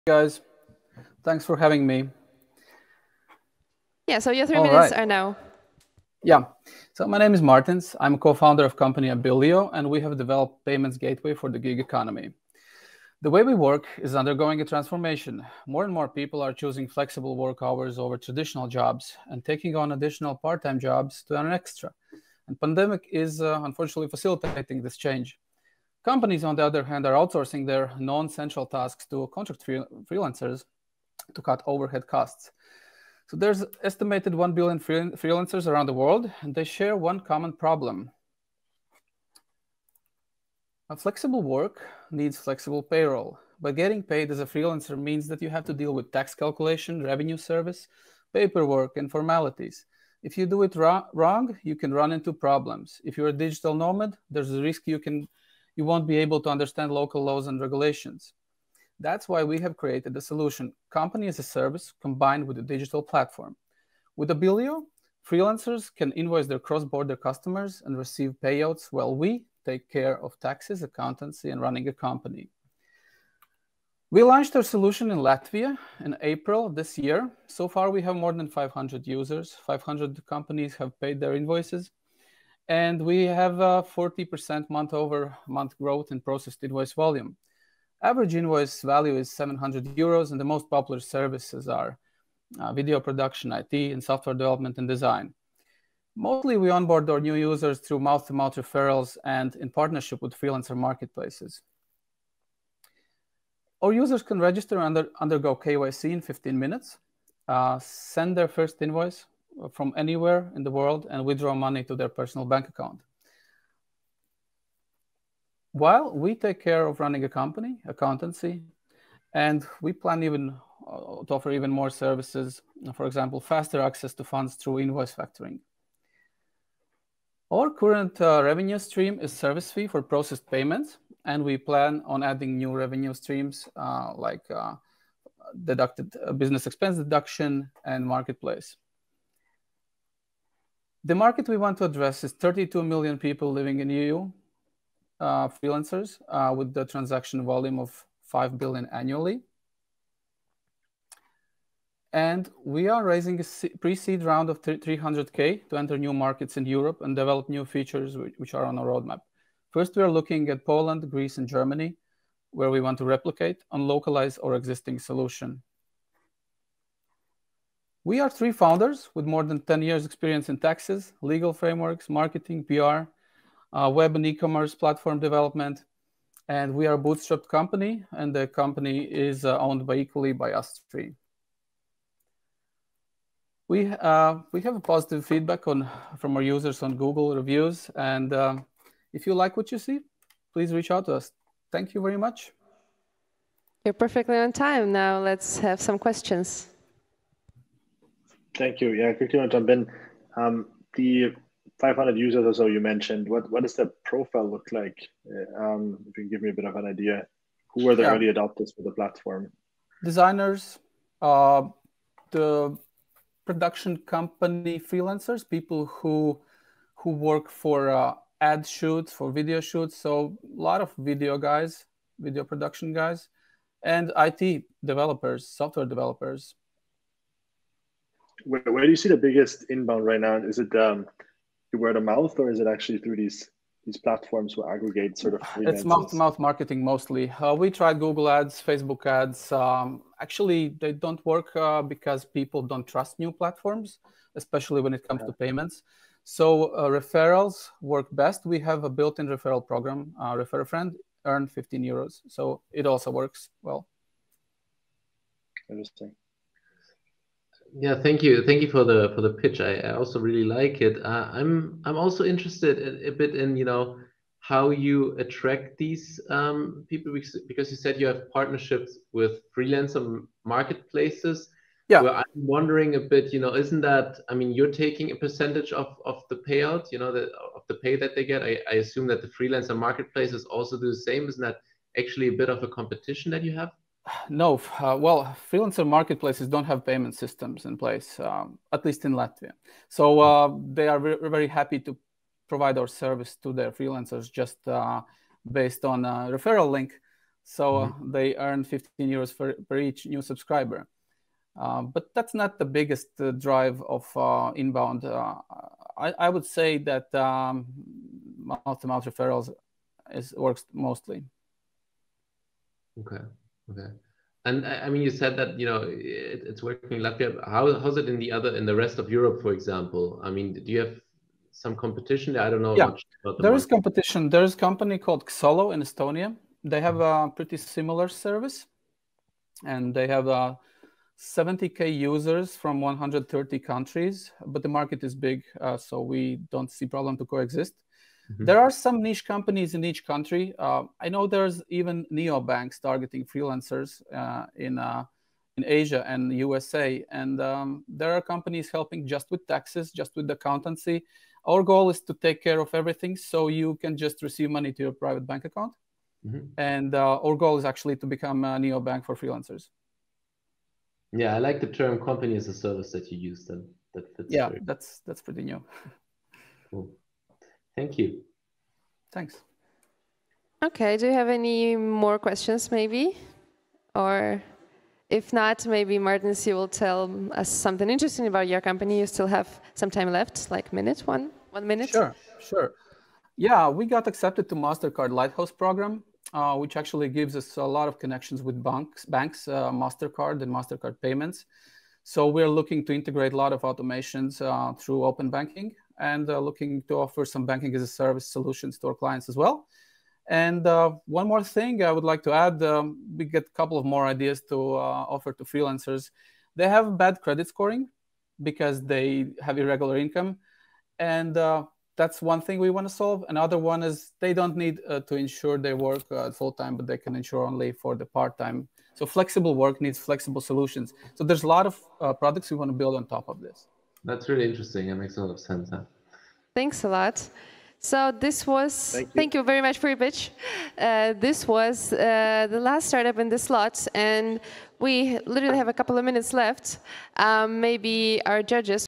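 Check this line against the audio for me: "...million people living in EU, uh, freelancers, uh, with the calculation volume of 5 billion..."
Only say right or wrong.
wrong.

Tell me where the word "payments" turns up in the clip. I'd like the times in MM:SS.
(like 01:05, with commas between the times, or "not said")
00:10, 02:10, 04:05, 04:46, 06:31.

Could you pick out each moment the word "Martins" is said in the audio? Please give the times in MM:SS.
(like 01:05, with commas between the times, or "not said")
00:07, 06:15.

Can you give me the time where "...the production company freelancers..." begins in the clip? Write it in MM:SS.
03:32.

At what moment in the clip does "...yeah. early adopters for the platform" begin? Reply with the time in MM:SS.
03:28.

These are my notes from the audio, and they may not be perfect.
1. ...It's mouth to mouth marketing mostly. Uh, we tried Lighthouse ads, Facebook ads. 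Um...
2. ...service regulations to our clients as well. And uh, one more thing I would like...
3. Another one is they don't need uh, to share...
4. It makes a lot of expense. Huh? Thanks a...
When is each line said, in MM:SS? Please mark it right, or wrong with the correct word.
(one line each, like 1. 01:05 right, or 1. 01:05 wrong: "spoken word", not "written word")
1. 03:55 wrong: "Google", not "Lighthouse"
2. 06:37 wrong: "solutions", not "regulations"
3. 06:53 wrong: "insure", not "share"
4. 07:04 wrong: "sense", not "expense".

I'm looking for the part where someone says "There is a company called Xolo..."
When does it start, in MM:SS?
05:24.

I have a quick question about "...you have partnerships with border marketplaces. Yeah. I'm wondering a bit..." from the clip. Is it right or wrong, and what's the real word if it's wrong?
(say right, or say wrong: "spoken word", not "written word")
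wrong: "freelancer", not "border".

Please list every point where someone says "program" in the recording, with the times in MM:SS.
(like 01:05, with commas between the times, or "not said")
04:09, 06:25.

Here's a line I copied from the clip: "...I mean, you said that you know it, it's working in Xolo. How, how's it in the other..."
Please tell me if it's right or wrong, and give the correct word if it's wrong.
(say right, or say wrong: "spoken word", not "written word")
wrong: "Latvia", not "Xolo".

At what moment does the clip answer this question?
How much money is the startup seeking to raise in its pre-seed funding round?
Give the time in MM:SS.
02:34.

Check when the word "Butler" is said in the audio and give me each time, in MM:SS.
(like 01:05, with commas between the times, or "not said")
not said.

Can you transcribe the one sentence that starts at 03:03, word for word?
We, uh, we have a positive feedback on, from our users on Google reviews.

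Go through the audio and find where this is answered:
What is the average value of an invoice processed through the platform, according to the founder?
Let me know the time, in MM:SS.
01:29.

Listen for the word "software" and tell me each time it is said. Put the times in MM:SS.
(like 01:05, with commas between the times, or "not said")
01:34, 03:45.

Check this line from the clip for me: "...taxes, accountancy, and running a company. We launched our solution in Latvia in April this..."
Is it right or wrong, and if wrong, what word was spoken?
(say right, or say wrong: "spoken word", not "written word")
right.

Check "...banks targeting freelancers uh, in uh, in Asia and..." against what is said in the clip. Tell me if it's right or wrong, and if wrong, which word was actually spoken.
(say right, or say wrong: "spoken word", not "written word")
right.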